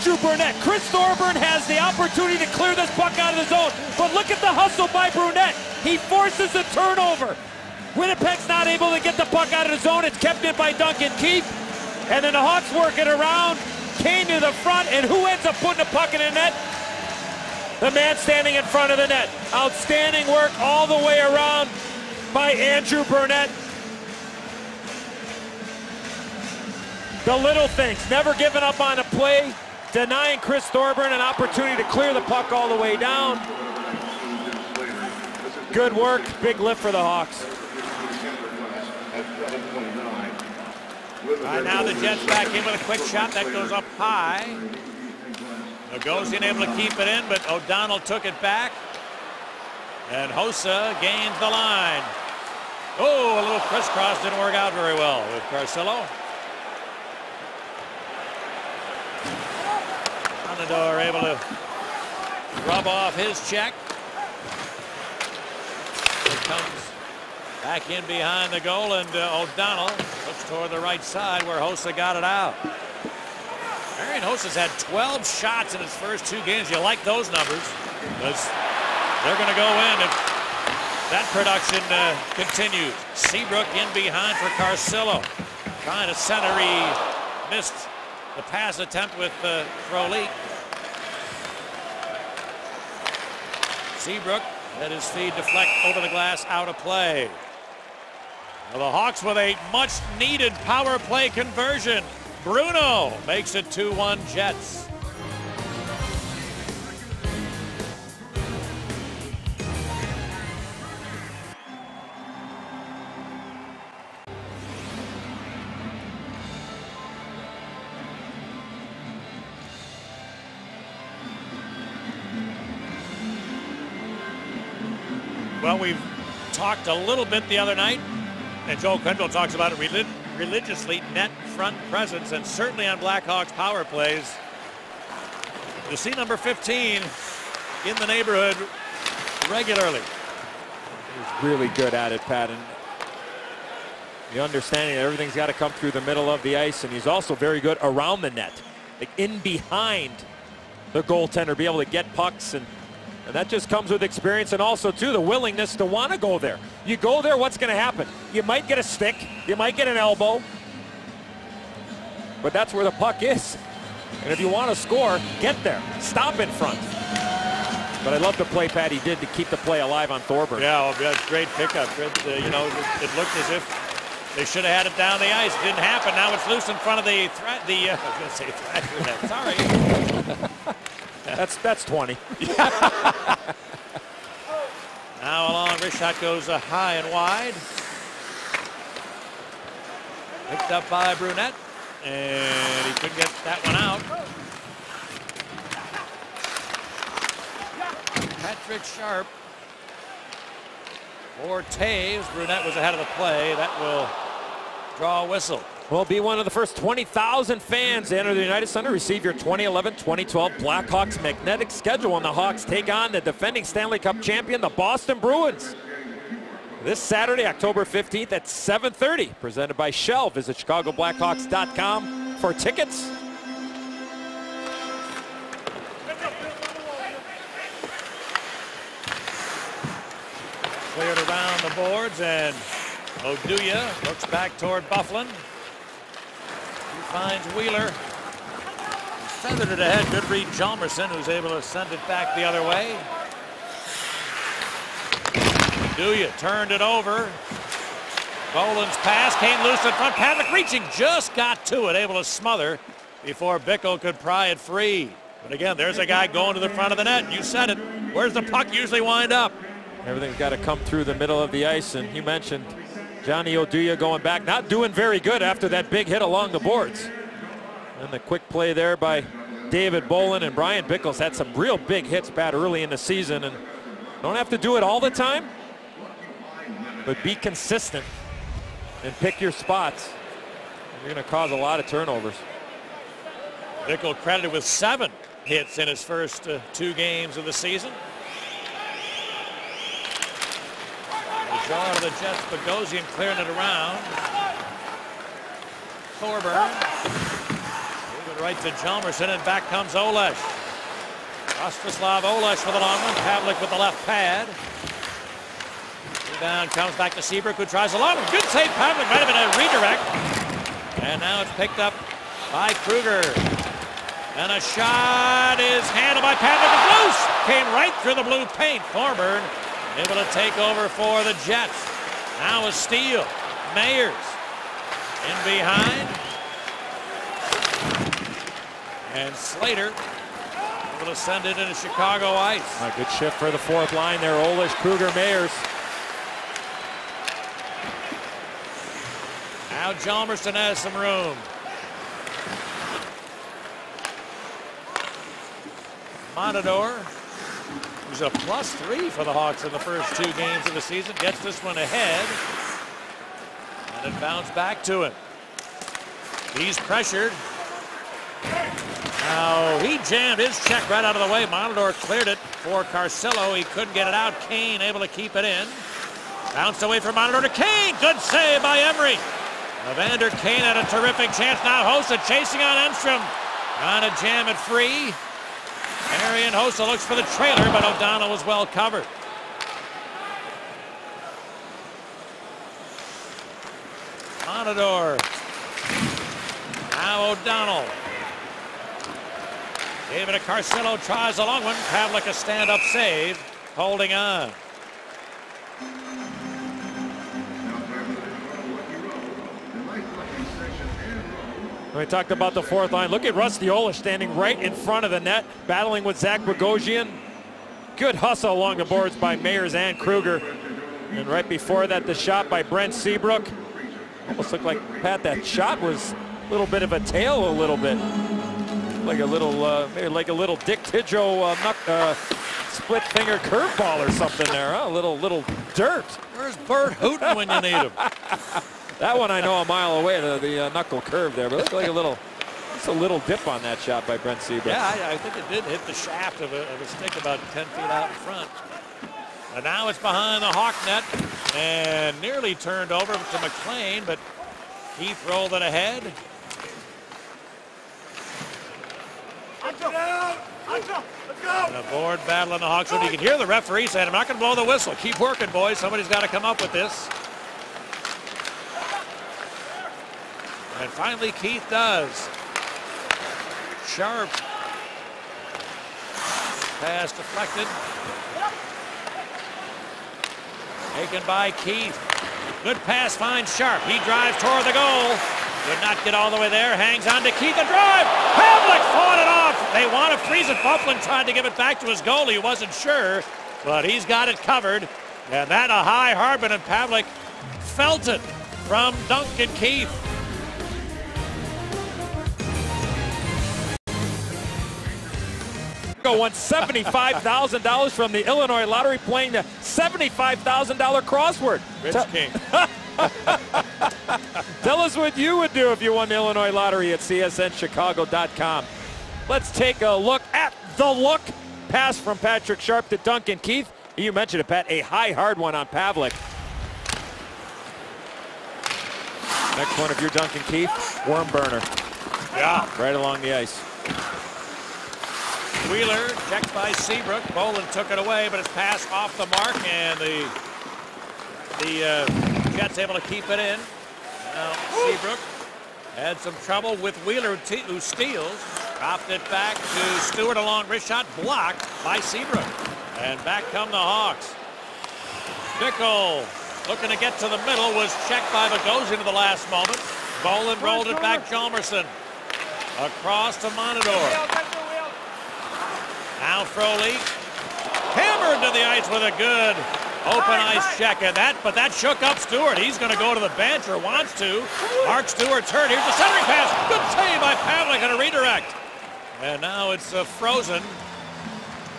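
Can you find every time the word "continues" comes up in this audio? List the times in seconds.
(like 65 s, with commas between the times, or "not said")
82 s.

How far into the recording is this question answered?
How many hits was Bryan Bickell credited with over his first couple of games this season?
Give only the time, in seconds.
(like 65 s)
284 s.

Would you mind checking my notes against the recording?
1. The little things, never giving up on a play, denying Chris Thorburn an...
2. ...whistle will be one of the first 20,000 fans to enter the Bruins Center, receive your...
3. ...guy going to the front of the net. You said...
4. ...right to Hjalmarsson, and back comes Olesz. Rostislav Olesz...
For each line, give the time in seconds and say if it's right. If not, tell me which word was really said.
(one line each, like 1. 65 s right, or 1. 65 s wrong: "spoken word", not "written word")
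1. 27 s right
2. 205 s wrong: "United", not "Bruins"
3. 256 s right
4. 298 s right.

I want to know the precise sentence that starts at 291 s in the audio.
The draw to the Jets, Bogosian clearing it around.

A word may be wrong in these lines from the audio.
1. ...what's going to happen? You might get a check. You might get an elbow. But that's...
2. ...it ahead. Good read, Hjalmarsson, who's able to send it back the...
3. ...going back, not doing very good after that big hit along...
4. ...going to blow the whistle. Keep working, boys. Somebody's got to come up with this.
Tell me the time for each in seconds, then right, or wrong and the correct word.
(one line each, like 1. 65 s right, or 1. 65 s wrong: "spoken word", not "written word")
1. 157 s wrong: "stick", not "check"
2. 239 s right
3. 263 s right
4. 454 s right.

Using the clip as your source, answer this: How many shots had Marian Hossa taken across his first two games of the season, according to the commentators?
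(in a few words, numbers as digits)
12.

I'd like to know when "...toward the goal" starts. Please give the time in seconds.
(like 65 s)
474 s.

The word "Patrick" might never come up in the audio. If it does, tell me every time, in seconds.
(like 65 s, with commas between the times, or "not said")
198 s, 512 s.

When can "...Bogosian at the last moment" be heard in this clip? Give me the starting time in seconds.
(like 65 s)
548 s.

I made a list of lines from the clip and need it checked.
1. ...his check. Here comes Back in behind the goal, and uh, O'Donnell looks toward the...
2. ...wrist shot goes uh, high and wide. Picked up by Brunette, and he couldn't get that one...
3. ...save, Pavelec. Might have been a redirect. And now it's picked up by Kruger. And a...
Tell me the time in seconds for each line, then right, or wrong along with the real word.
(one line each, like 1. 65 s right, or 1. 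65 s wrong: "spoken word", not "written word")
1. 63 s right
2. 185 s right
3. 308 s right.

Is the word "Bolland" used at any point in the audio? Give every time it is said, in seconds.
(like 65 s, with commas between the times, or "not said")
248 s, 270 s, 527 s, 550 s.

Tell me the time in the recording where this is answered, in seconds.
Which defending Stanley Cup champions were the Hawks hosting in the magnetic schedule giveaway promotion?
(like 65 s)
214 s.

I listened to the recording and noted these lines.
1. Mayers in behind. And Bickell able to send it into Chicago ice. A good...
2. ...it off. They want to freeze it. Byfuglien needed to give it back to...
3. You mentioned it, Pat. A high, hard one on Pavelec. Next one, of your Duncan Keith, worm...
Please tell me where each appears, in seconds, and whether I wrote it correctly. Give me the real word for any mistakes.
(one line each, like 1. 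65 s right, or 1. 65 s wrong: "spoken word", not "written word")
1. 323 s wrong: "Slater", not "Bickell"
2. 479 s wrong: "tried", not "needed"
3. 513 s right.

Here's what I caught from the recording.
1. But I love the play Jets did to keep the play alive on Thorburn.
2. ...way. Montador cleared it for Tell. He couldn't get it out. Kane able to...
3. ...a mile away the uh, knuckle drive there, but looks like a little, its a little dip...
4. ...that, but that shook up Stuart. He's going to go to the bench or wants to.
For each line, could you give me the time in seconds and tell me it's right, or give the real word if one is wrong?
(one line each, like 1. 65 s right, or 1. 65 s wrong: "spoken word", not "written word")
1. 168 s wrong: "Patty", not "Jets"
2. 361 s wrong: "Carcillo", not "Tell"
3. 429 s wrong: "curve", not "drive"
4. 561 s right.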